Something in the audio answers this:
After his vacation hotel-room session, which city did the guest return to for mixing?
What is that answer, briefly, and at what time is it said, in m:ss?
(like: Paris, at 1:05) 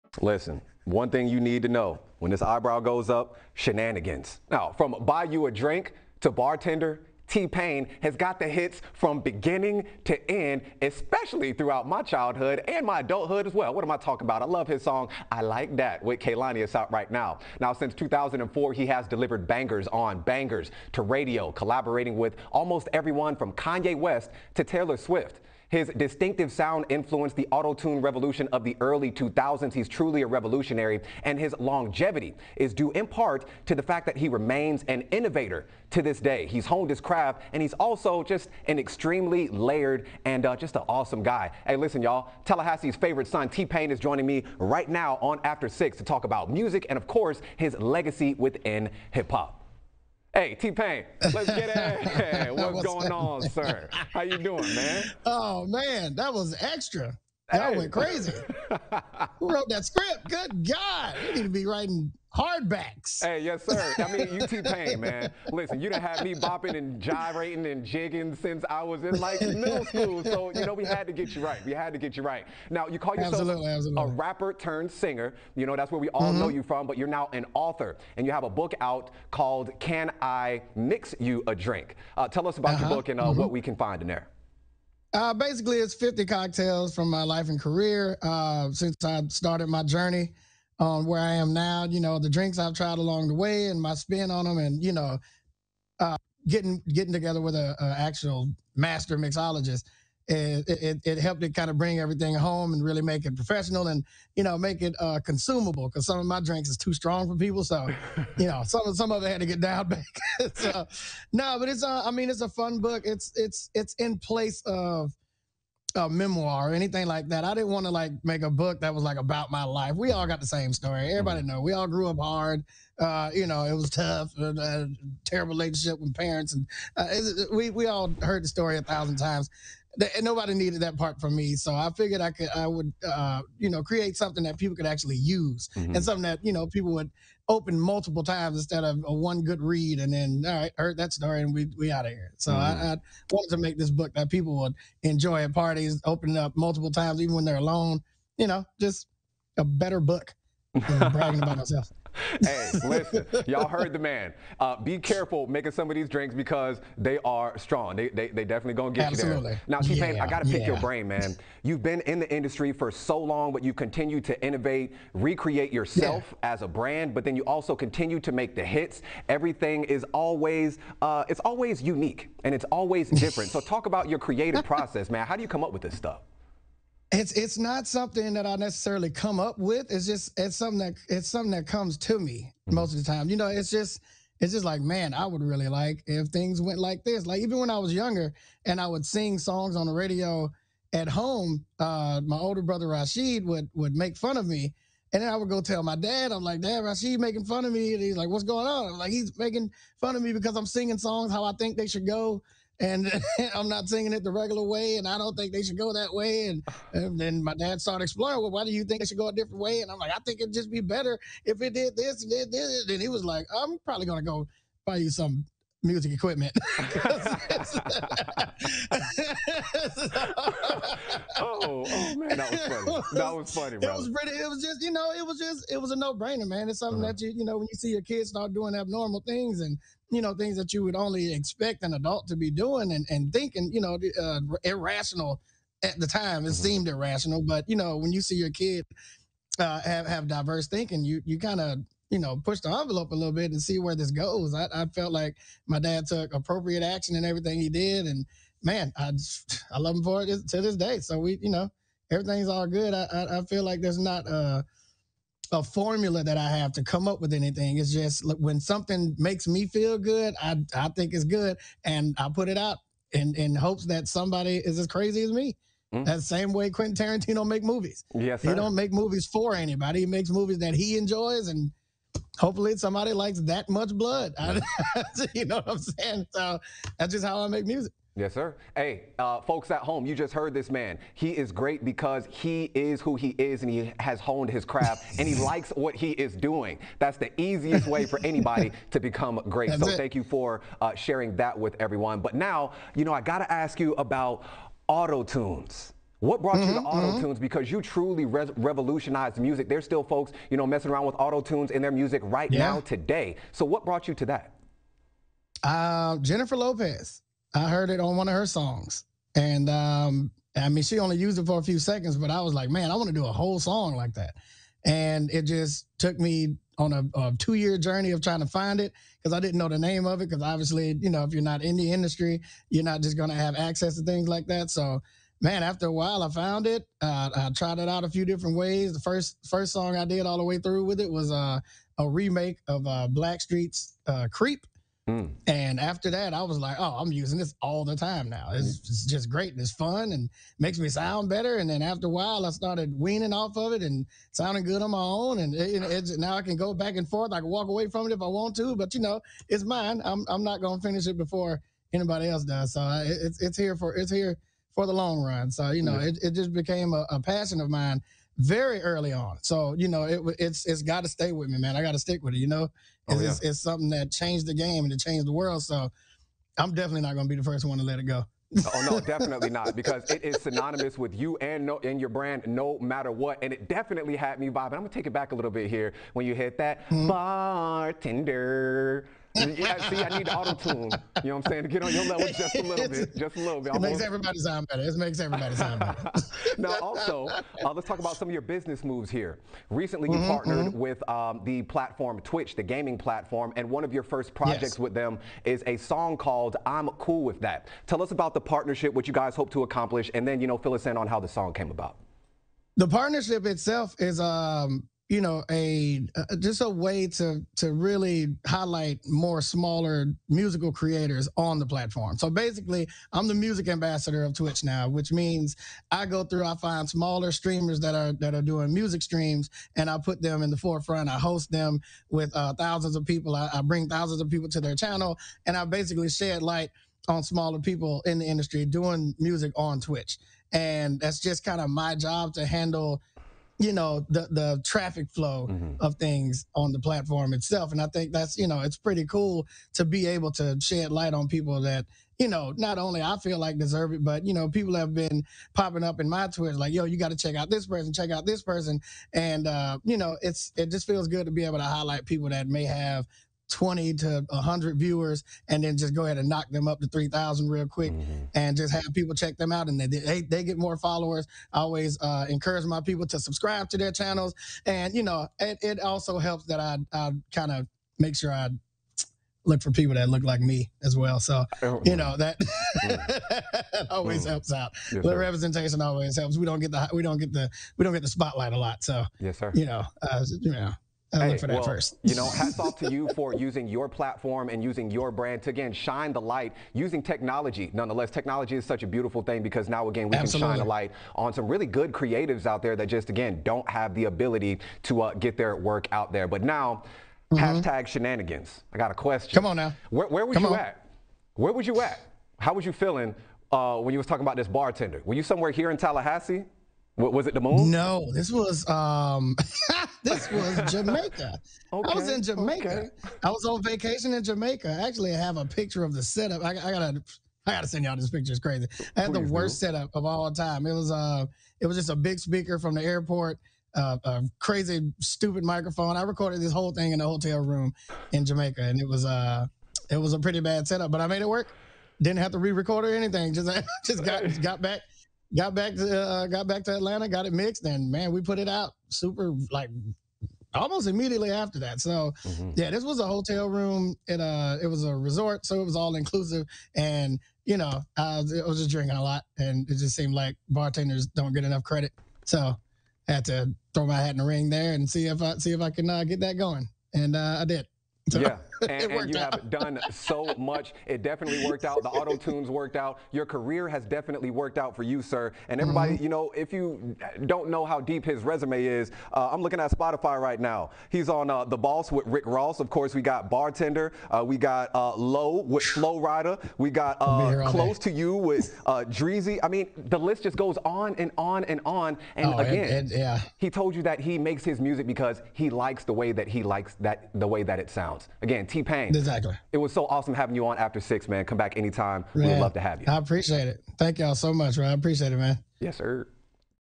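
Atlanta, at 8:56.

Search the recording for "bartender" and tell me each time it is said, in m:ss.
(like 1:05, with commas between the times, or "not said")
0:06, 6:17, 8:24, 9:10, 9:33.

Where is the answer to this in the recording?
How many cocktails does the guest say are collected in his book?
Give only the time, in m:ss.
1:25.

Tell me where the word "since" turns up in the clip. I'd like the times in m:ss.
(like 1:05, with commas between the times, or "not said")
0:17, 1:08, 1:28.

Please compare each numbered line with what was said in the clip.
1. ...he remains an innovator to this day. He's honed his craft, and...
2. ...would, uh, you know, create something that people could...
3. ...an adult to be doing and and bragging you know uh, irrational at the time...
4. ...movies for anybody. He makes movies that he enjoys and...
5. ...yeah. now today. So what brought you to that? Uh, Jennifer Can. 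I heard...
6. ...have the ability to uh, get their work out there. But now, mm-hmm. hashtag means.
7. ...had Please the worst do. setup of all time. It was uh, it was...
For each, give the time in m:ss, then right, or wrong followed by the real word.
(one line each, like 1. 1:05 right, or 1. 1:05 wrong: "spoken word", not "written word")
1. 0:34 right
2. 2:12 right
3. 3:51 wrong: "thinking", not "bragging"
4. 4:28 right
5. 5:02 wrong: "Lopez", not "Can"
6. 8:13 wrong: "shenanigans", not "means"
7. 8:39 right.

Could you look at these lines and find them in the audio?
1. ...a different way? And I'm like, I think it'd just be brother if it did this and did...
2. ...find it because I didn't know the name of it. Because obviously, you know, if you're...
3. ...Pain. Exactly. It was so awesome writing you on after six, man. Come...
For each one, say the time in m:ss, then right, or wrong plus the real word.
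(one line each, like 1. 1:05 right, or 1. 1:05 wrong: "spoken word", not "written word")
1. 3:29 wrong: "better", not "brother"
2. 5:18 right
3. 9:48 wrong: "having", not "writing".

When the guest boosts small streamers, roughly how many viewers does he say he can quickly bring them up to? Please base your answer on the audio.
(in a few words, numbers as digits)
3,000.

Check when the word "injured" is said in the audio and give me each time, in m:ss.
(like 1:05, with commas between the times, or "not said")
not said.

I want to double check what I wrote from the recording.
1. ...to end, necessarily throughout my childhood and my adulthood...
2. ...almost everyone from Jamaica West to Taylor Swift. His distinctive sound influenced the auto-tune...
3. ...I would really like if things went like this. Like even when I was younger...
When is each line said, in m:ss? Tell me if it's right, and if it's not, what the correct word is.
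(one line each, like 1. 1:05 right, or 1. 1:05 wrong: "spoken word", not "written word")
1. 0:10 wrong: "especially", not "necessarily"
2. 0:22 wrong: "Kanye", not "Jamaica"
3. 3:05 right.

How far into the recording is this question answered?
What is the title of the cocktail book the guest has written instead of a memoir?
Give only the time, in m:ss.
1:19.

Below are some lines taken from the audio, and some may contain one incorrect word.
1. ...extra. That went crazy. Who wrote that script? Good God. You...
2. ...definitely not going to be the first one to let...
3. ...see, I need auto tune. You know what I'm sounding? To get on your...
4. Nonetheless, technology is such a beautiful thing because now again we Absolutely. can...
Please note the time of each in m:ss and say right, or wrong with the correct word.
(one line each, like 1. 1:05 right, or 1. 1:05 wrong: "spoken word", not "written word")
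1. 0:56 right
2. 6:06 right
3. 6:19 wrong: "saying", not "sounding"
4. 8:07 right.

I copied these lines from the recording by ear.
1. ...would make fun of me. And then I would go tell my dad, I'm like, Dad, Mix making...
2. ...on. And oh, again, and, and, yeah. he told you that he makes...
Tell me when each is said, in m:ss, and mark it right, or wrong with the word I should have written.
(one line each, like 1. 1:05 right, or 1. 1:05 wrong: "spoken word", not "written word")
1. 3:13 wrong: "Rashid", not "Mix"
2. 9:41 right.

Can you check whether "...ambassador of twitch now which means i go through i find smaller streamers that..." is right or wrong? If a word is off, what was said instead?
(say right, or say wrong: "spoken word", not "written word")
right.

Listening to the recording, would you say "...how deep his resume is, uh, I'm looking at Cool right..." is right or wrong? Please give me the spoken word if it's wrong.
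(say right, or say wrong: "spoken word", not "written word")
wrong: "Spotify", not "Cool".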